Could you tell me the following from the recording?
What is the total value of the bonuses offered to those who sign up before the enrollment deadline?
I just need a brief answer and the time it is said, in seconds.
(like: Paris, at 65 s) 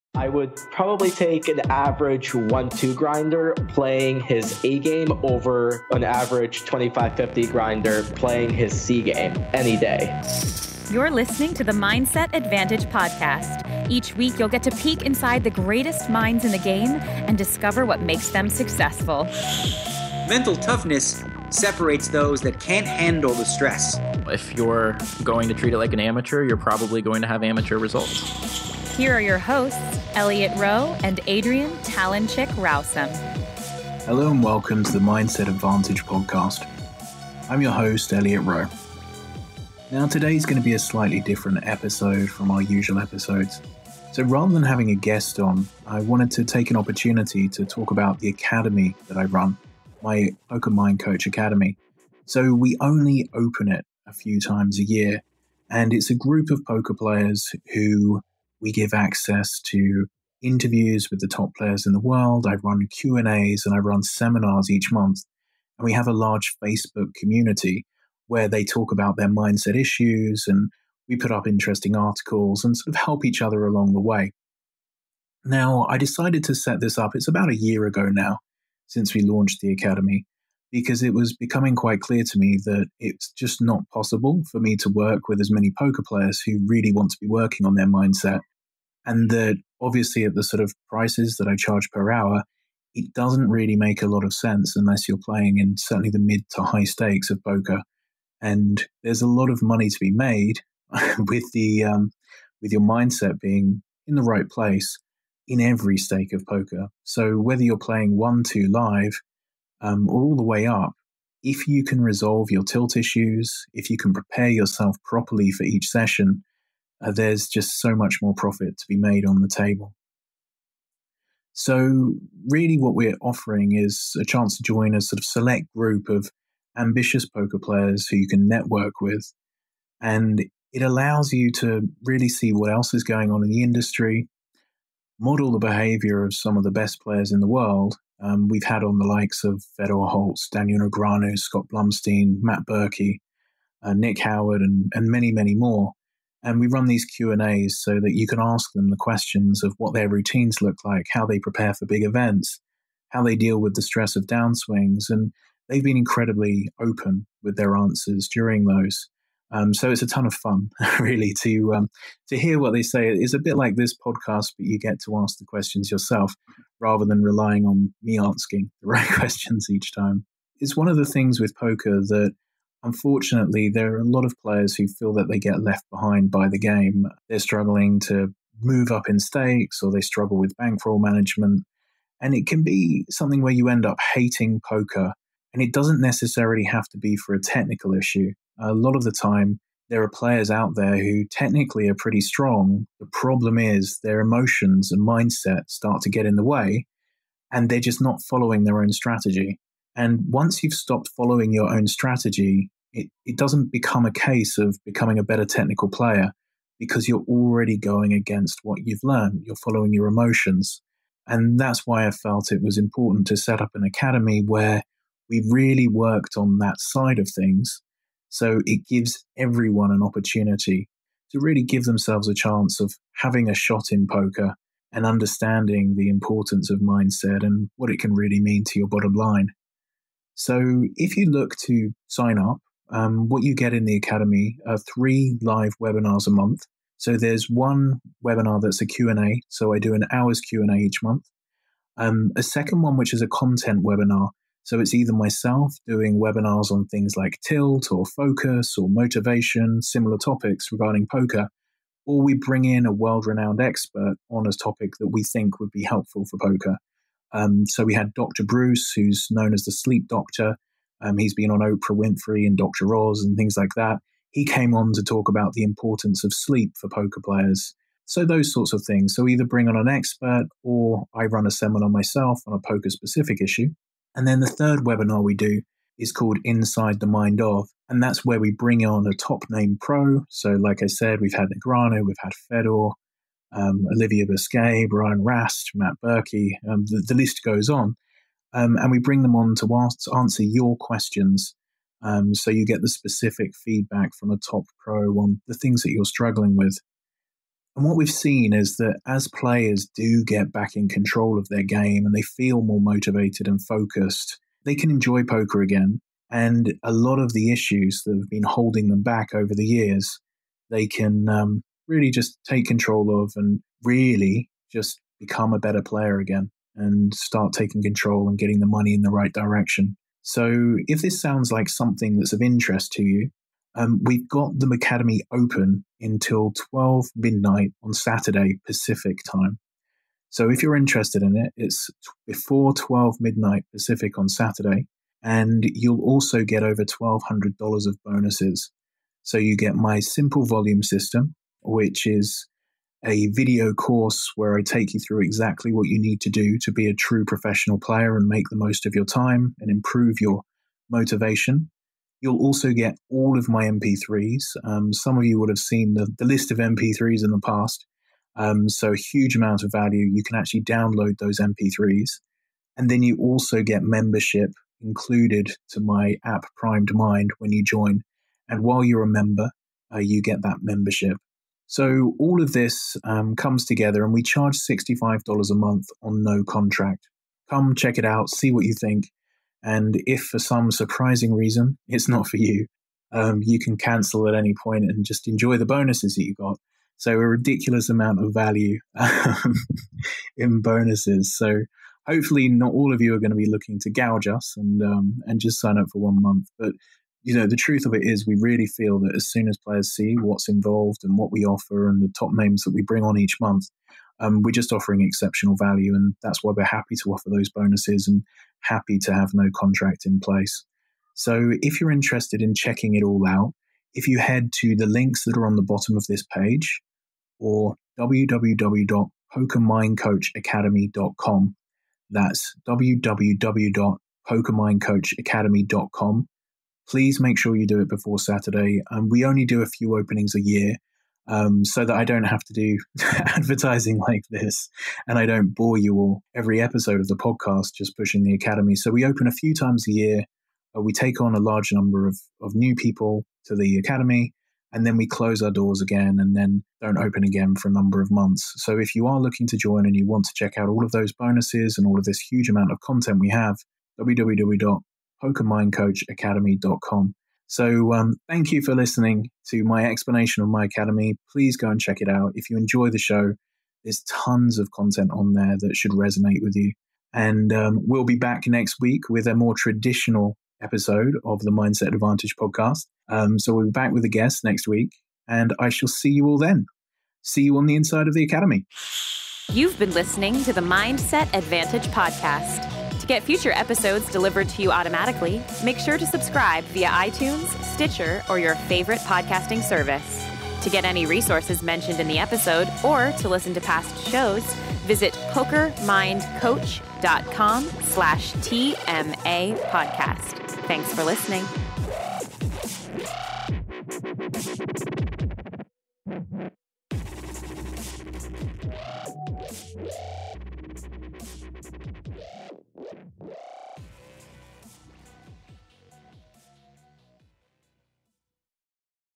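over $1,200, at 336 s.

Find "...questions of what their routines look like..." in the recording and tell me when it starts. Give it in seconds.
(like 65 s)
148 s.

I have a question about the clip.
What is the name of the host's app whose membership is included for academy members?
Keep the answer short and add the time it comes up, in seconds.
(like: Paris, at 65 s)
Primed Mind, at 366 s.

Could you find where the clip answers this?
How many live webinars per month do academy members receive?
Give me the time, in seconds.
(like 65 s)
234 s.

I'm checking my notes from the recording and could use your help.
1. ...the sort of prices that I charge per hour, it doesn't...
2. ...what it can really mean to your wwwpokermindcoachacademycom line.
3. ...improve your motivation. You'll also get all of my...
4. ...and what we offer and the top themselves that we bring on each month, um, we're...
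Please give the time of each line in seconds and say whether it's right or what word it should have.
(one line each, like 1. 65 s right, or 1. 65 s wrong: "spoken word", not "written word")
1. 90 s right
2. 227 s wrong: "bottom", not "wwwpokermindcoachacademycom"
3. 349 s right
4. 401 s wrong: "names", not "themselves".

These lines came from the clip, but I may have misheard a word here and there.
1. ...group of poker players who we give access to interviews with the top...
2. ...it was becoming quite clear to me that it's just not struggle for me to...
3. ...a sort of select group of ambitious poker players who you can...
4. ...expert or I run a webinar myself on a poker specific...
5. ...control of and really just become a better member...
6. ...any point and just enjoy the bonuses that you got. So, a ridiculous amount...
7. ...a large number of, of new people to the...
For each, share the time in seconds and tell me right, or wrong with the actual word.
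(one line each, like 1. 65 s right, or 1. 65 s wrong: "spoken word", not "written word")
1. 56 s right
2. 81 s wrong: "possible", not "struggle"
3. 124 s right
4. 269 s wrong: "seminar", not "webinar"
5. 312 s wrong: "player", not "member"
6. 384 s right
7. 441 s right.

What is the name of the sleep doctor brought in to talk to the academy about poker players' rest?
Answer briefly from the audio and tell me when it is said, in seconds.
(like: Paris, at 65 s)
Dr. Breus, at 258 s.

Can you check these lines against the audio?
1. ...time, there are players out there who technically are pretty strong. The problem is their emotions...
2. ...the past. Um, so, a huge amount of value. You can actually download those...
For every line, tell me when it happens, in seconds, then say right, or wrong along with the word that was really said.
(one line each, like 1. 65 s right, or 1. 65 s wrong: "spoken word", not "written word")
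1. 189 s right
2. 357 s right.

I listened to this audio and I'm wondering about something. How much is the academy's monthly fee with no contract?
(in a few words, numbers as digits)
$65.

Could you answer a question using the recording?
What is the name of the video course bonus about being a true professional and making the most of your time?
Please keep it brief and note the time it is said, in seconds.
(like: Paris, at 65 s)
simple volume system, at 340 s.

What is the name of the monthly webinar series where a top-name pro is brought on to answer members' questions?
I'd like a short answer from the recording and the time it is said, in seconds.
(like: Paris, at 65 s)
Inside the Mind of, at 276 s.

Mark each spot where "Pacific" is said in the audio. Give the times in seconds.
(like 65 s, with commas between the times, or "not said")
328 s, 333 s.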